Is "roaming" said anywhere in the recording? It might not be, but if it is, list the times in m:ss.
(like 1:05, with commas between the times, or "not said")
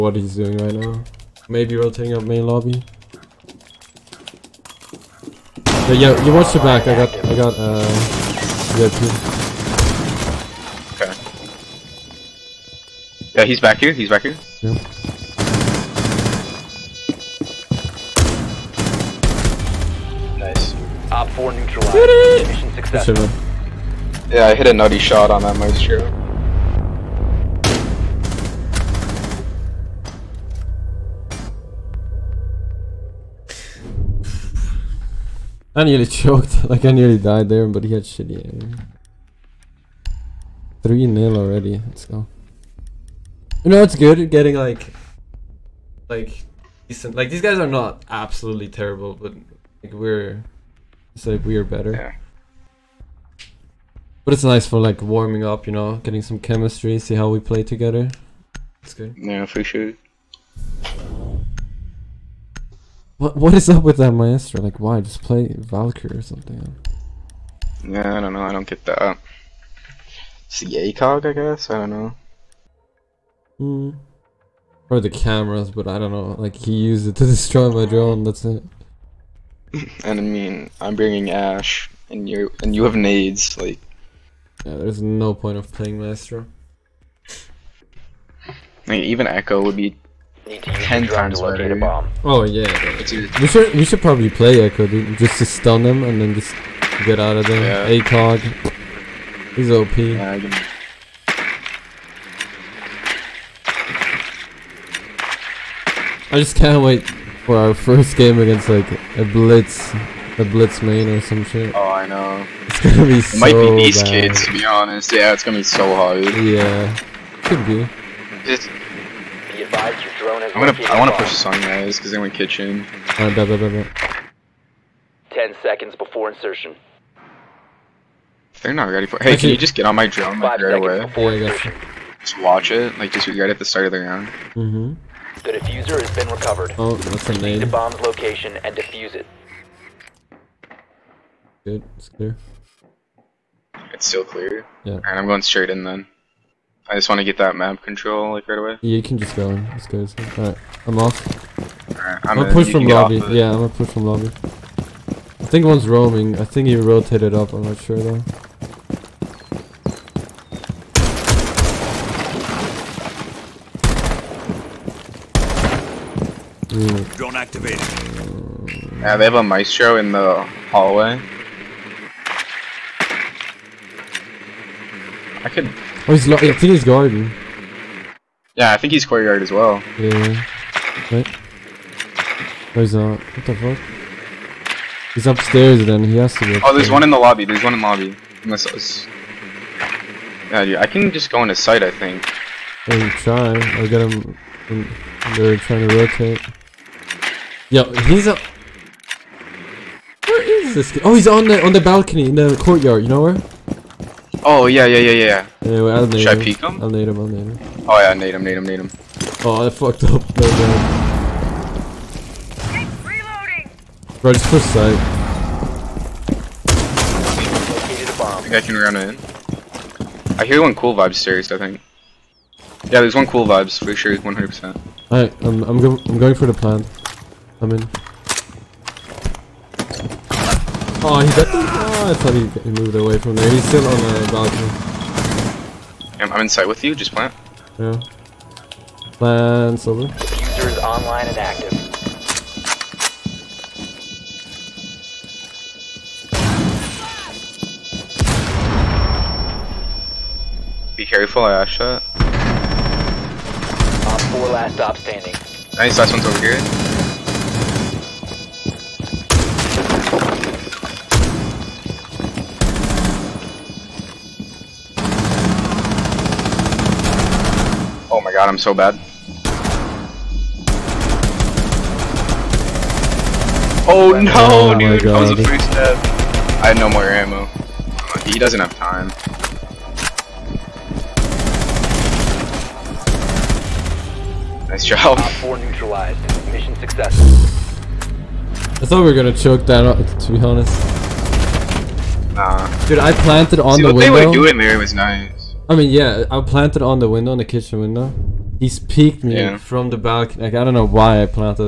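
2:35.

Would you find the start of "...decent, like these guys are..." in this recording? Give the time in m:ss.
0:46.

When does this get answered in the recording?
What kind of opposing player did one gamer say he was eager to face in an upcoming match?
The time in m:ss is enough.
1:50.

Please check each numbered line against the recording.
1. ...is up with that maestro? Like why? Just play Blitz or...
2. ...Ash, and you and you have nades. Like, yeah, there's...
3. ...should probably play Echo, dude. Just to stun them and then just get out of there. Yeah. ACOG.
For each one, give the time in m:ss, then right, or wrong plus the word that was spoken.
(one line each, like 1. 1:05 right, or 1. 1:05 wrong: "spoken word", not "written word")
1. 1:03 wrong: "Valkyrie", not "Blitz"
2. 1:21 right
3. 1:33 right.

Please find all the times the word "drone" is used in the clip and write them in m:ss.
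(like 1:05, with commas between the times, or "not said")
1:17, 2:00, 2:10, 2:47.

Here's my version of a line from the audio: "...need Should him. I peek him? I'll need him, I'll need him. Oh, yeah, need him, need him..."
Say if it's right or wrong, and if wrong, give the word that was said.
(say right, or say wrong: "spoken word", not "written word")
right.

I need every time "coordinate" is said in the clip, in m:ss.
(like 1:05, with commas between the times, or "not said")
not said.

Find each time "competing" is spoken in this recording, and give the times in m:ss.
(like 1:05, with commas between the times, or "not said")
not said.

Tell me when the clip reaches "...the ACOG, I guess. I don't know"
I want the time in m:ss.
1:10.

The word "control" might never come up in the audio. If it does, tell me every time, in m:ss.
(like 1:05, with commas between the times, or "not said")
2:27.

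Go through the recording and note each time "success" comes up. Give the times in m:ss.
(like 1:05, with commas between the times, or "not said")
0:22, 4:46.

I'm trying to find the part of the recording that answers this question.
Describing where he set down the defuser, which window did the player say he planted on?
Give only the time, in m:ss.
4:57.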